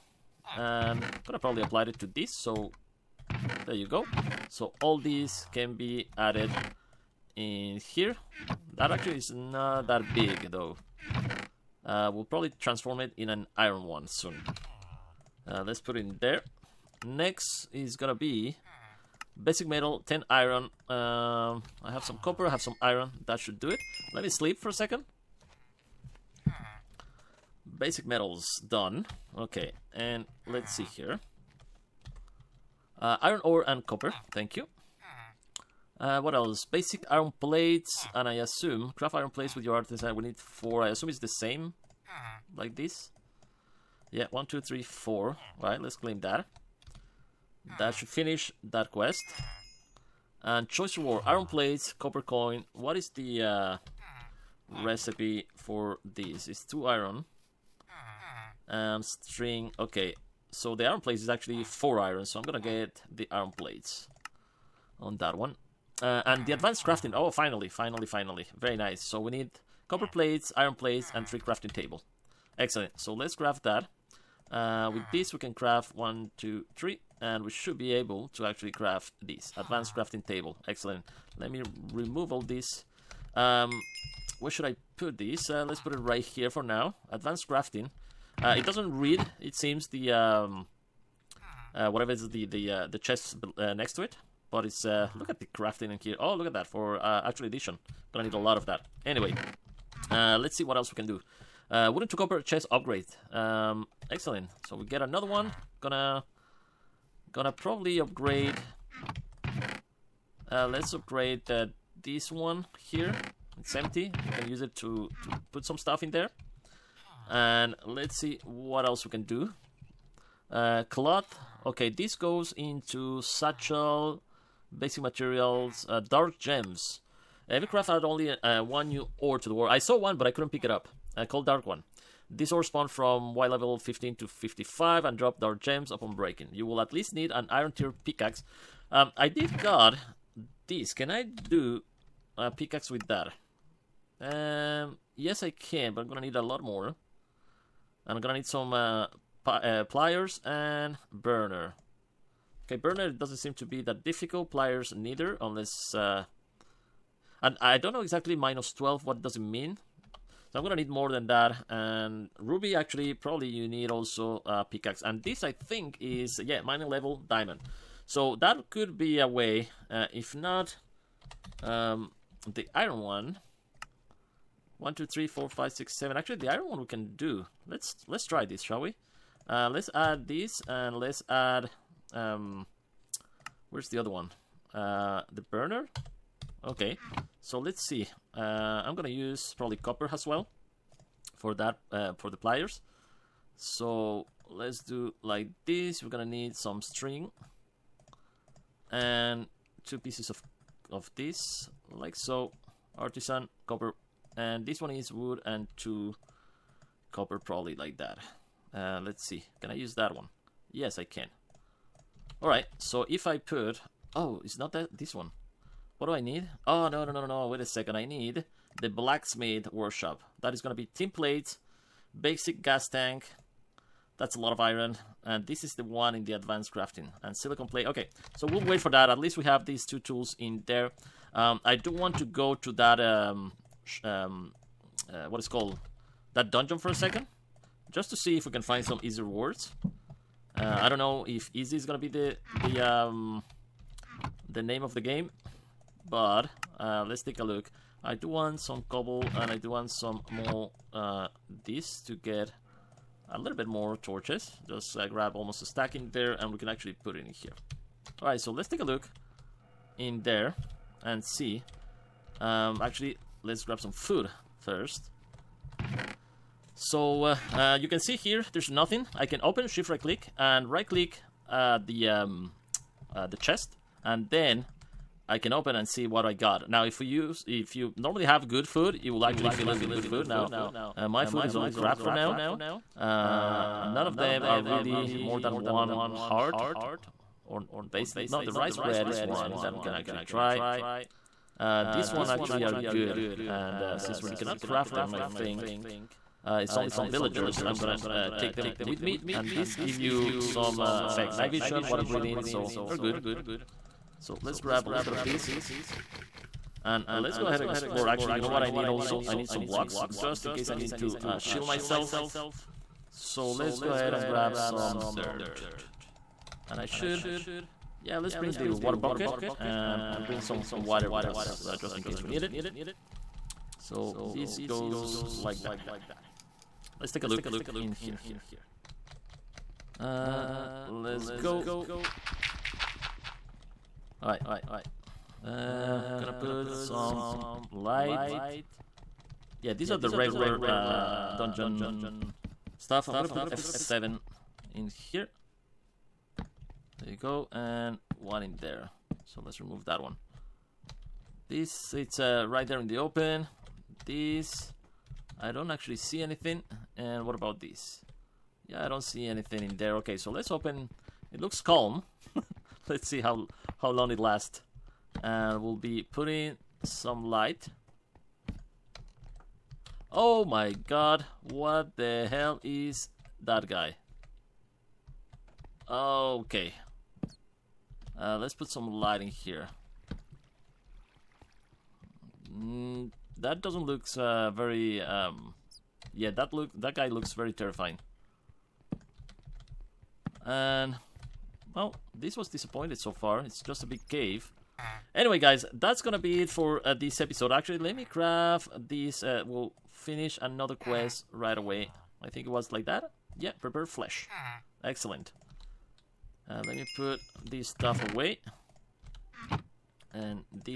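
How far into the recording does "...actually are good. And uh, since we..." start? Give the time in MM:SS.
04:52.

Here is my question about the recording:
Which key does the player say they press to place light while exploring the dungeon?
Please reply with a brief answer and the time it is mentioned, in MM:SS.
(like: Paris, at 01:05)
F7, at 05:43.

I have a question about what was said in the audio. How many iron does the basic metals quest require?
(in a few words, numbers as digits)
10.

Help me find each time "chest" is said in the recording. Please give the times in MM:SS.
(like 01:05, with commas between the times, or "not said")
01:32, 01:42, 04:33.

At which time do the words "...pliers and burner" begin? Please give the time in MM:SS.
02:29.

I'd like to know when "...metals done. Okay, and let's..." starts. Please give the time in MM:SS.
00:28.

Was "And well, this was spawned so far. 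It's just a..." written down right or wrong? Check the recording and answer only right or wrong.
wrong.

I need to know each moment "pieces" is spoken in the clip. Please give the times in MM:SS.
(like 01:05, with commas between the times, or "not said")
03:19.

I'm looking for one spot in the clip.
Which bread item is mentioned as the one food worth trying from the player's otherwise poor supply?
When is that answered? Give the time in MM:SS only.
04:48.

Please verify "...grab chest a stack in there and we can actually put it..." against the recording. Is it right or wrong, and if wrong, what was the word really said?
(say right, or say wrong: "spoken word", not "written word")
wrong: "almost", not "chest".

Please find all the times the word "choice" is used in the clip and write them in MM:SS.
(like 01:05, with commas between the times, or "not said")
00:50.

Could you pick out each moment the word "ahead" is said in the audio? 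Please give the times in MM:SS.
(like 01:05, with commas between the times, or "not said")
05:07, 05:13.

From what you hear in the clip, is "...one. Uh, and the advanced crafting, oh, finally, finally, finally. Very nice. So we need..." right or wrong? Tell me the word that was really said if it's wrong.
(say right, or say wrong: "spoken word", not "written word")
right.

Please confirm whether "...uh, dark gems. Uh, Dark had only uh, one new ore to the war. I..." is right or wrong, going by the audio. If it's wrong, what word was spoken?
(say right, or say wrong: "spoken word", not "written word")
wrong: "EvilCraft", not "Dark".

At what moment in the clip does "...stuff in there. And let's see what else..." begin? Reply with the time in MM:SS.
01:55.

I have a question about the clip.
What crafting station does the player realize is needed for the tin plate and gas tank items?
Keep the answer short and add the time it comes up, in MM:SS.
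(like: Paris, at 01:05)
blacksmith workshop, at 03:38.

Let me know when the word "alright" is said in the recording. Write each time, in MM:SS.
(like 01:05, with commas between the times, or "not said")
03:32, 04:18, 05:34.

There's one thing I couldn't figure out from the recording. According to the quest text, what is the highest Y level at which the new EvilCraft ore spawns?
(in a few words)
55.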